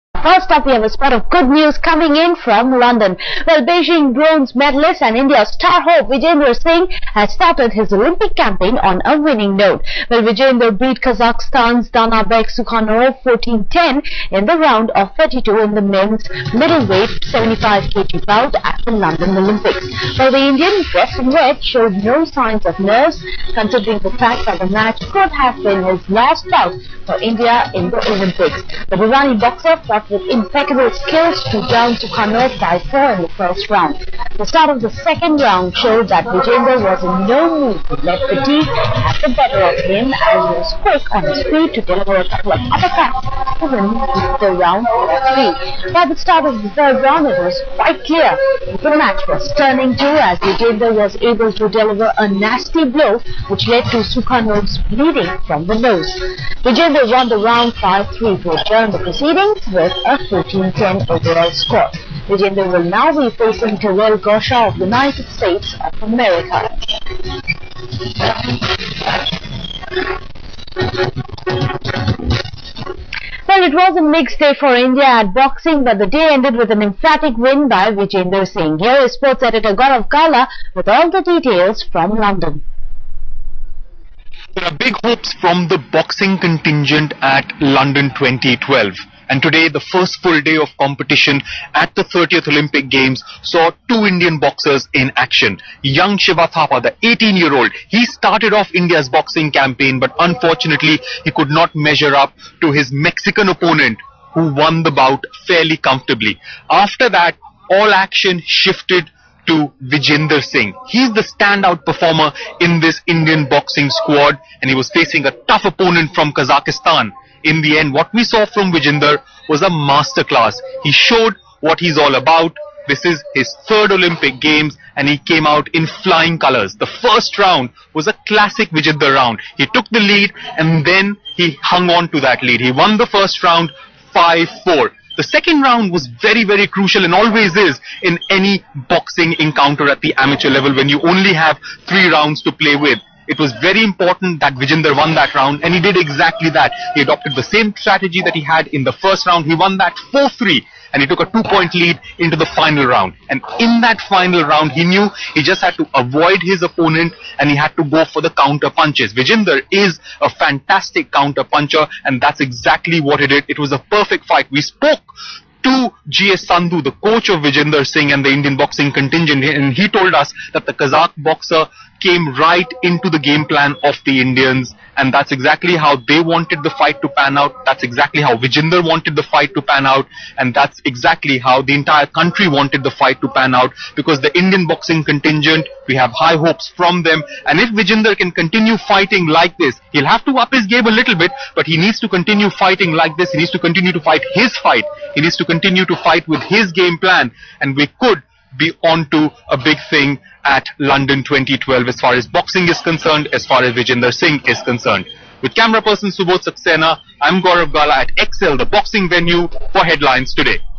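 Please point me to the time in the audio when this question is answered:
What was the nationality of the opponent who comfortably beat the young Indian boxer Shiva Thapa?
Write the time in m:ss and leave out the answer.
1:42.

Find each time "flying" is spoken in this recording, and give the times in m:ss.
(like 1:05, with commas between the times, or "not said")
2:06.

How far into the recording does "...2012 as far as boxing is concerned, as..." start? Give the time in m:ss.
3:21.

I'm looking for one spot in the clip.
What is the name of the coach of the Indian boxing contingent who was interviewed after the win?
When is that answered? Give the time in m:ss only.
2:46.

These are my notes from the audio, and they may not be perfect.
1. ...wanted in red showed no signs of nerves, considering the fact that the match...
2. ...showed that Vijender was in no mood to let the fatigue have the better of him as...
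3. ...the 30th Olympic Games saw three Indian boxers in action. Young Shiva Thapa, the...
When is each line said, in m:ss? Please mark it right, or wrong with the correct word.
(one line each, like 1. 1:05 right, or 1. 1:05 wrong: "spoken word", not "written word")
1. 0:20 wrong: "dressed", not "wanted"
2. 0:35 right
3. 1:31 wrong: "two", not "three".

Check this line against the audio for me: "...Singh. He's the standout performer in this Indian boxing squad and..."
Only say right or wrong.
right.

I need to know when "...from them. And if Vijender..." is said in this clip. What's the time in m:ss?
3:06.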